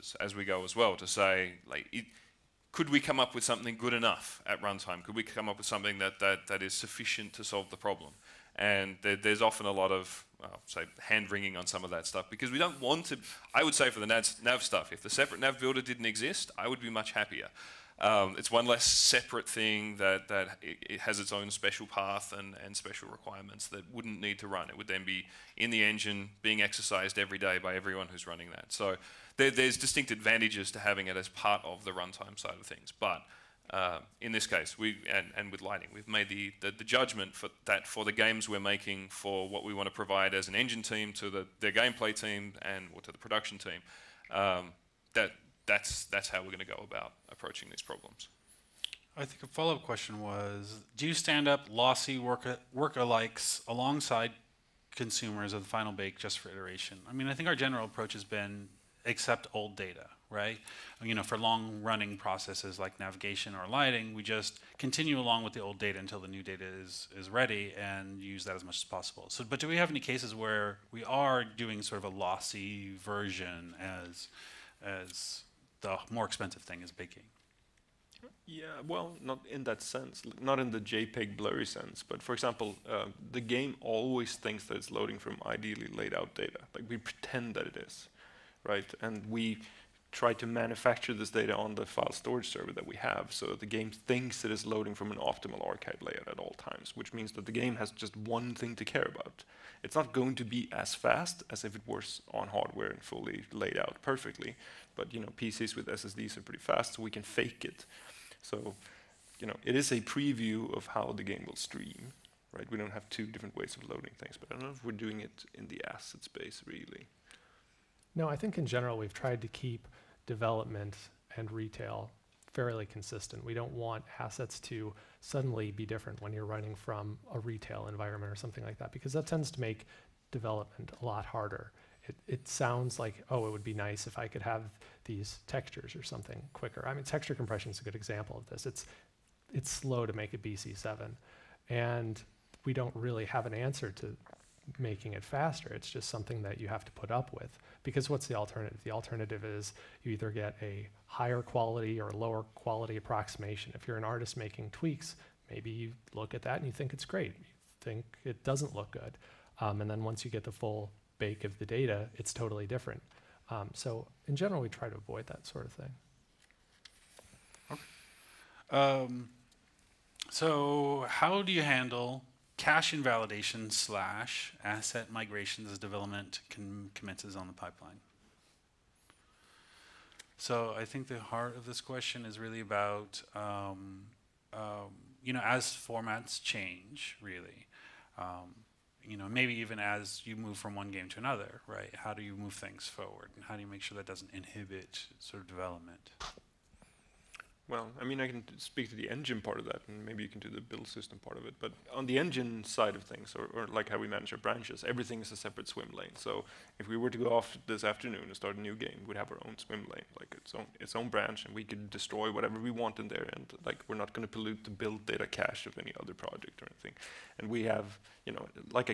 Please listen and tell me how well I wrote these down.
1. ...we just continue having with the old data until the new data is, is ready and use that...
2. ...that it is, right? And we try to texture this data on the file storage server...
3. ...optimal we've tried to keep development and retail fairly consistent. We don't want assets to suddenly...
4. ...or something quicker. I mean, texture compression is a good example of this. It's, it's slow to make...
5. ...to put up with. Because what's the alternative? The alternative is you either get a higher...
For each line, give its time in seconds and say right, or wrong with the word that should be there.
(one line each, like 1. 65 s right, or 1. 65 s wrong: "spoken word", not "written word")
1. 64 s wrong: "along", not "having"
2. 87 s wrong: "manufacture", not "texture"
3. 118 s wrong: "general", not "optimal"
4. 135 s right
5. 146 s right.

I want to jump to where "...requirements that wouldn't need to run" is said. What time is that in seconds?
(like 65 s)
23 s.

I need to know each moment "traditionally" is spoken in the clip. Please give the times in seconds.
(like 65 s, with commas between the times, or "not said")
not said.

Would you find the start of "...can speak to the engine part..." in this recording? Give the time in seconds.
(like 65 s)
198 s.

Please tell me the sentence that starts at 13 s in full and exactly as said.
I would say for the nav, nav stuff, if the separate nav builder didn't exist, I would be much happier.